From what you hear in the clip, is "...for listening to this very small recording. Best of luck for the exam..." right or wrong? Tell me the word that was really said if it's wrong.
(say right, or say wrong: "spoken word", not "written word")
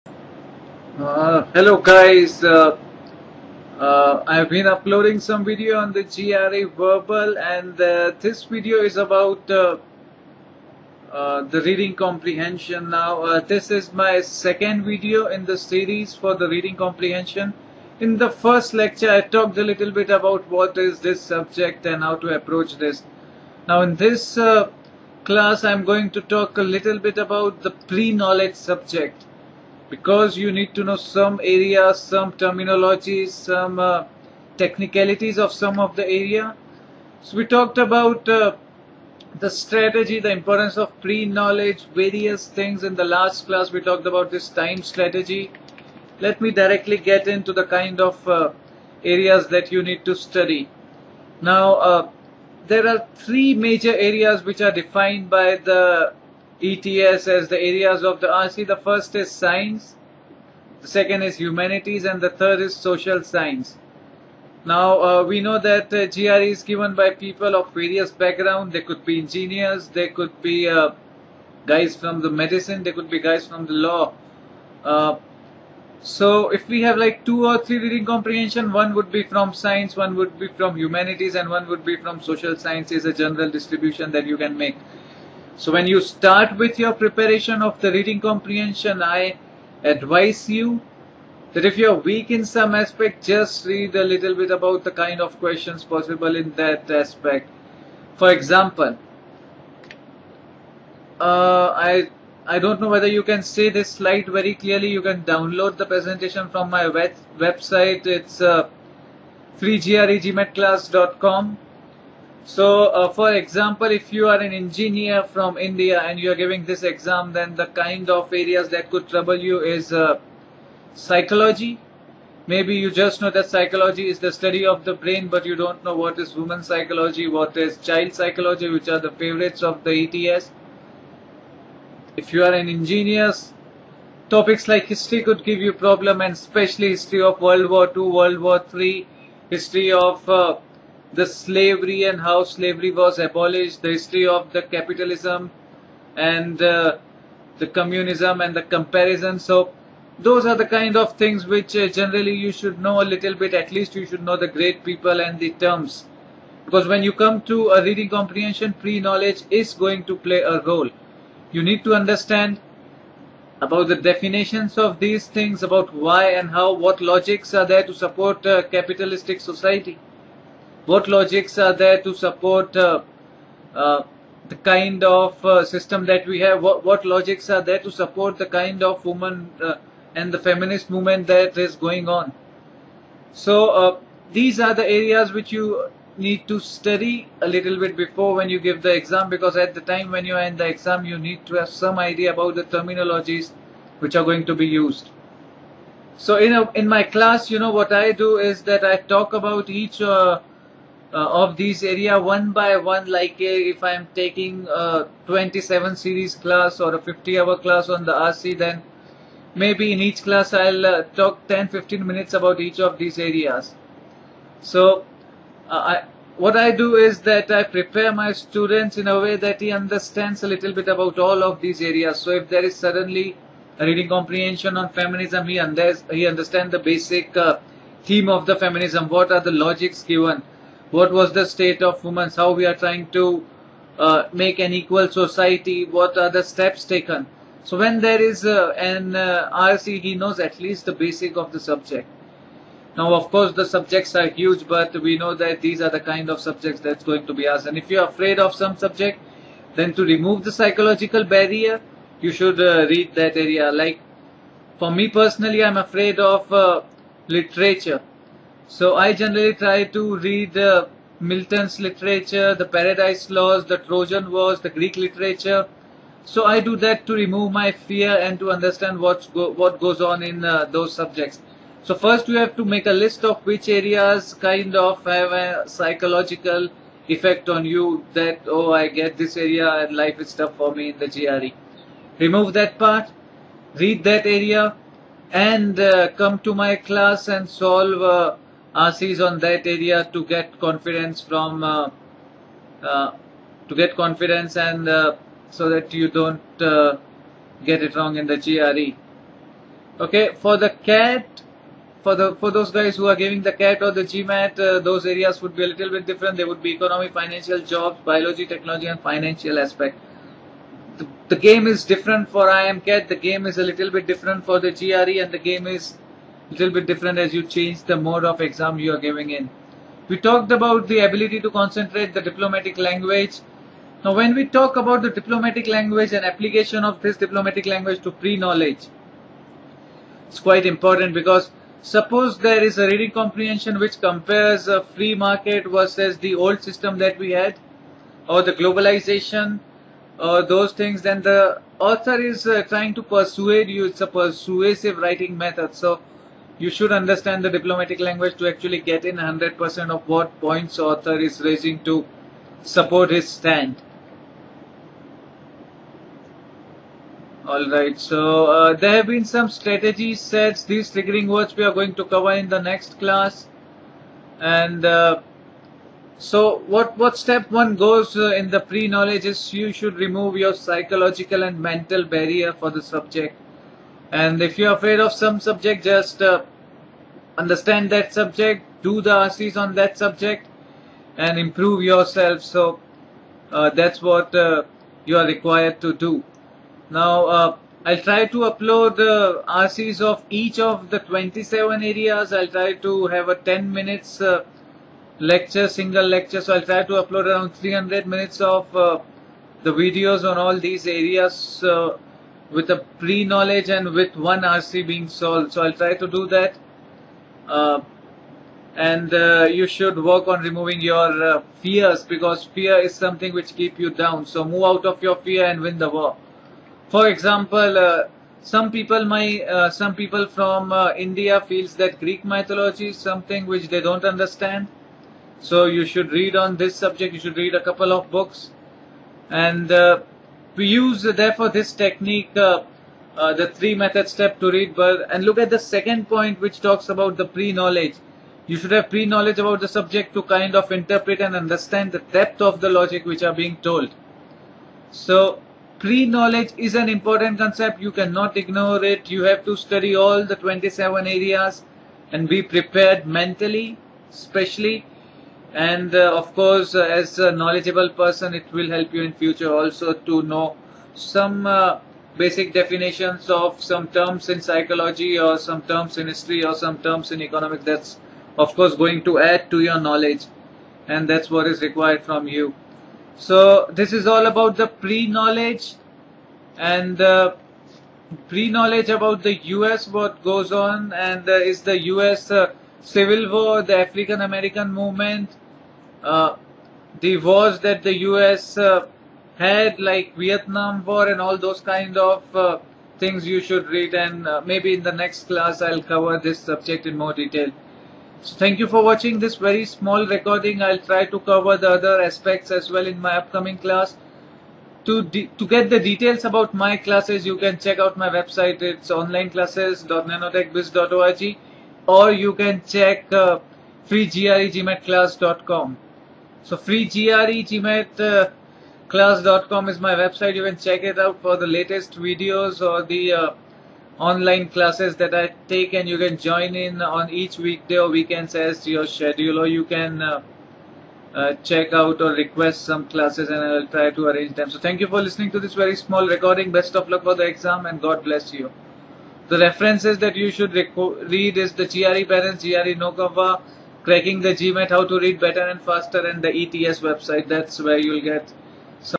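right.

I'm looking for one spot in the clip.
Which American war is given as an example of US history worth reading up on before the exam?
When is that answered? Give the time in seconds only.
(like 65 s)
490 s.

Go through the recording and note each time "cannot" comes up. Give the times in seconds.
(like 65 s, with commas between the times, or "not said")
447 s.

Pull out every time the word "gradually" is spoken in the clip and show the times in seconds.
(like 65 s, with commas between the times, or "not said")
not said.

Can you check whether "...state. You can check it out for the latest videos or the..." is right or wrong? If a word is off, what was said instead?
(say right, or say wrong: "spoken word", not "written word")
wrong: "website", not "state".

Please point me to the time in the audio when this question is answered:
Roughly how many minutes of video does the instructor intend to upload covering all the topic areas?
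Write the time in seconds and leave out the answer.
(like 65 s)
397 s.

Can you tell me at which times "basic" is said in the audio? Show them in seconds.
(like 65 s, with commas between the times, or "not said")
226 s, 240 s, 462 s.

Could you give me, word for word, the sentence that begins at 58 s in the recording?
The first is science, the second is humanities, and the third is social science.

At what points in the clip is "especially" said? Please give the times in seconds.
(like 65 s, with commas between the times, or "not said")
136 s, 454 s.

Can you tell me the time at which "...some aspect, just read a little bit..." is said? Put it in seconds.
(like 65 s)
92 s.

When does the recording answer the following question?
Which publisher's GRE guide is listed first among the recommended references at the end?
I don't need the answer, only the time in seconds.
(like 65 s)
542 s.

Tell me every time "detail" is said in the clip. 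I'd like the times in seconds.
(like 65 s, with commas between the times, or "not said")
497 s, 505 s.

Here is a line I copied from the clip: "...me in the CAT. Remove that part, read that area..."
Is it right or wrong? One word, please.
wrong.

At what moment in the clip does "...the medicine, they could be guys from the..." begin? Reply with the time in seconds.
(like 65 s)
72 s.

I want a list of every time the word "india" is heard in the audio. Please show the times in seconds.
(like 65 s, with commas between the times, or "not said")
115 s, 421 s.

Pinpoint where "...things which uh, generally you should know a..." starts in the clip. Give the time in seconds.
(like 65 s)
151 s.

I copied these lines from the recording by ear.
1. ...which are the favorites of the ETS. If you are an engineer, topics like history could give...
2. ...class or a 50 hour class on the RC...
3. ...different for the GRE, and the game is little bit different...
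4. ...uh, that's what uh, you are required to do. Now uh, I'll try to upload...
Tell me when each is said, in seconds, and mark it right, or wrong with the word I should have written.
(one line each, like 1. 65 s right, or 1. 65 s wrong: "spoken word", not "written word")
1. 128 s right
2. 206 s right
3. 314 s right
4. 383 s right.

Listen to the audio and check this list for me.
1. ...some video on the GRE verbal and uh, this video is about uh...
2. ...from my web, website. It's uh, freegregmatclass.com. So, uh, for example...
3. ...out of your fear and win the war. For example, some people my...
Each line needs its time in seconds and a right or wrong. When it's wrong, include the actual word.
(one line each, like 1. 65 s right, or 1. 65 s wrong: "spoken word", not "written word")
1. 5 s right
2. 106 s right
3. 414 s right.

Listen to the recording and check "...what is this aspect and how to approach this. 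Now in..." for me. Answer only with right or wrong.
wrong.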